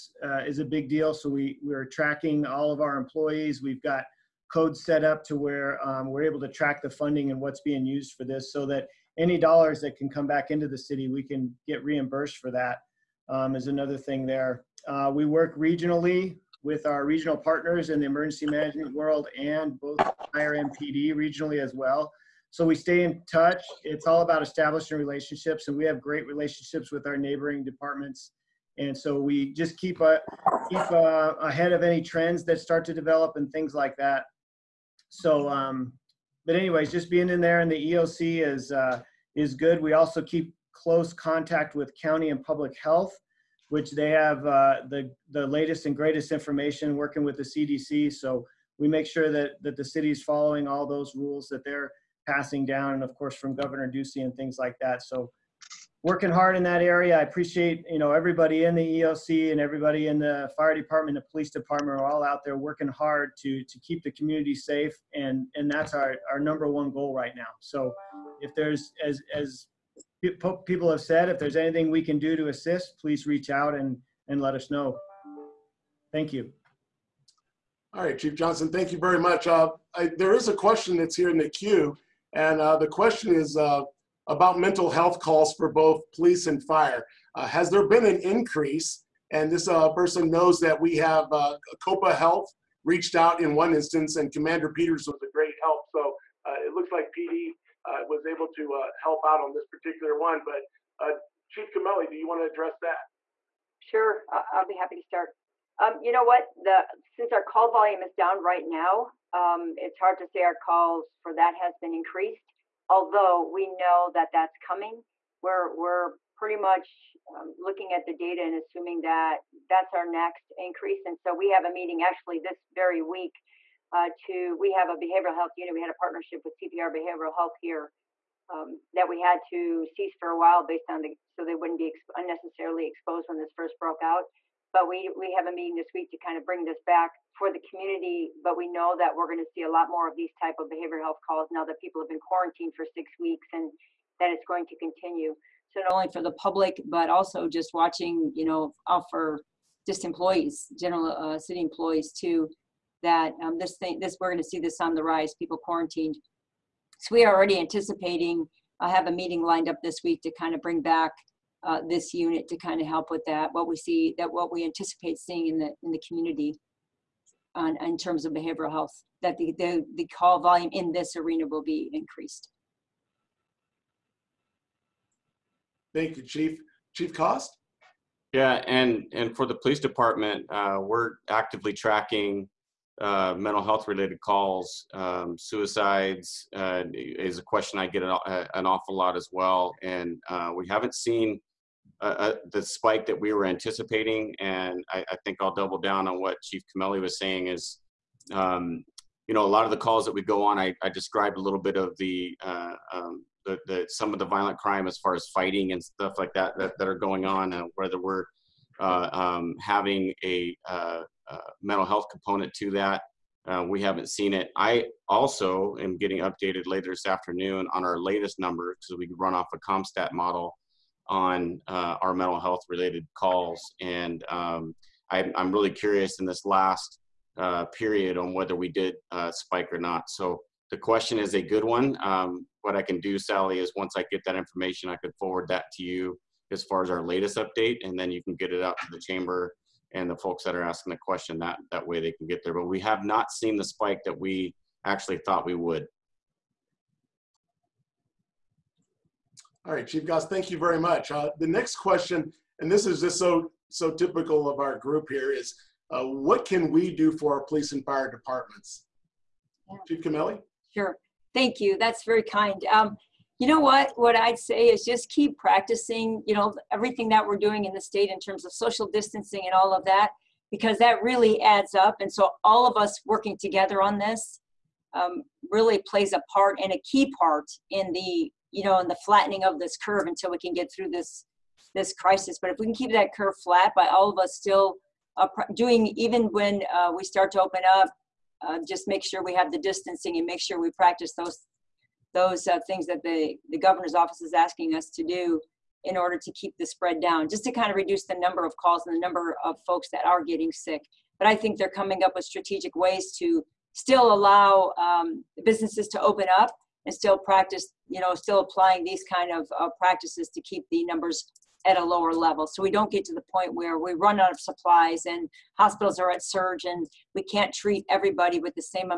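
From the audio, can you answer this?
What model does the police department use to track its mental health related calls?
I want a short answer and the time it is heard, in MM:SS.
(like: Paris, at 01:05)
CompStat, at 03:39.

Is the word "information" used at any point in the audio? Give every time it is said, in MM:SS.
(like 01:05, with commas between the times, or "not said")
00:46, 03:54.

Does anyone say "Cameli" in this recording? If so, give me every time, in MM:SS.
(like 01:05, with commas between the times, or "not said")
01:41, 03:16, 04:20.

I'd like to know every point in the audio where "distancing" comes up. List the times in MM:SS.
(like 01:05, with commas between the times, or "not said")
04:28, 04:49.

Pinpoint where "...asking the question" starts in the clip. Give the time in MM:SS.
04:00.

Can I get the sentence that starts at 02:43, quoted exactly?
What we see that what we anticipate seeing in the in the community.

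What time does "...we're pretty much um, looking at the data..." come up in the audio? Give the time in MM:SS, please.
01:55.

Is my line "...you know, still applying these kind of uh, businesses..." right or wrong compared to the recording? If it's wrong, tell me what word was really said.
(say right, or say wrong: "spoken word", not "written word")
wrong: "practices", not "businesses".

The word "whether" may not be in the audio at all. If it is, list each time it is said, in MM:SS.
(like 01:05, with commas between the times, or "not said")
03:27, 03:48.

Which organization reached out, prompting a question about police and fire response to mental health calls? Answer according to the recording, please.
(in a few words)
COPA Health.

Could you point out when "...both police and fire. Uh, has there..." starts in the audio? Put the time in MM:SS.
01:25.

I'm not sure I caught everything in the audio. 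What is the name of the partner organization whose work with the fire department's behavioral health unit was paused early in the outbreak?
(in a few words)
CPR Behavioral Health.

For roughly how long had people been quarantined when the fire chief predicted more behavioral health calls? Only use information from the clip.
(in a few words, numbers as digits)
6 weeks.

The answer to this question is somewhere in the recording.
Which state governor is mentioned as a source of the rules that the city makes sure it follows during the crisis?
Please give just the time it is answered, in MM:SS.
00:53.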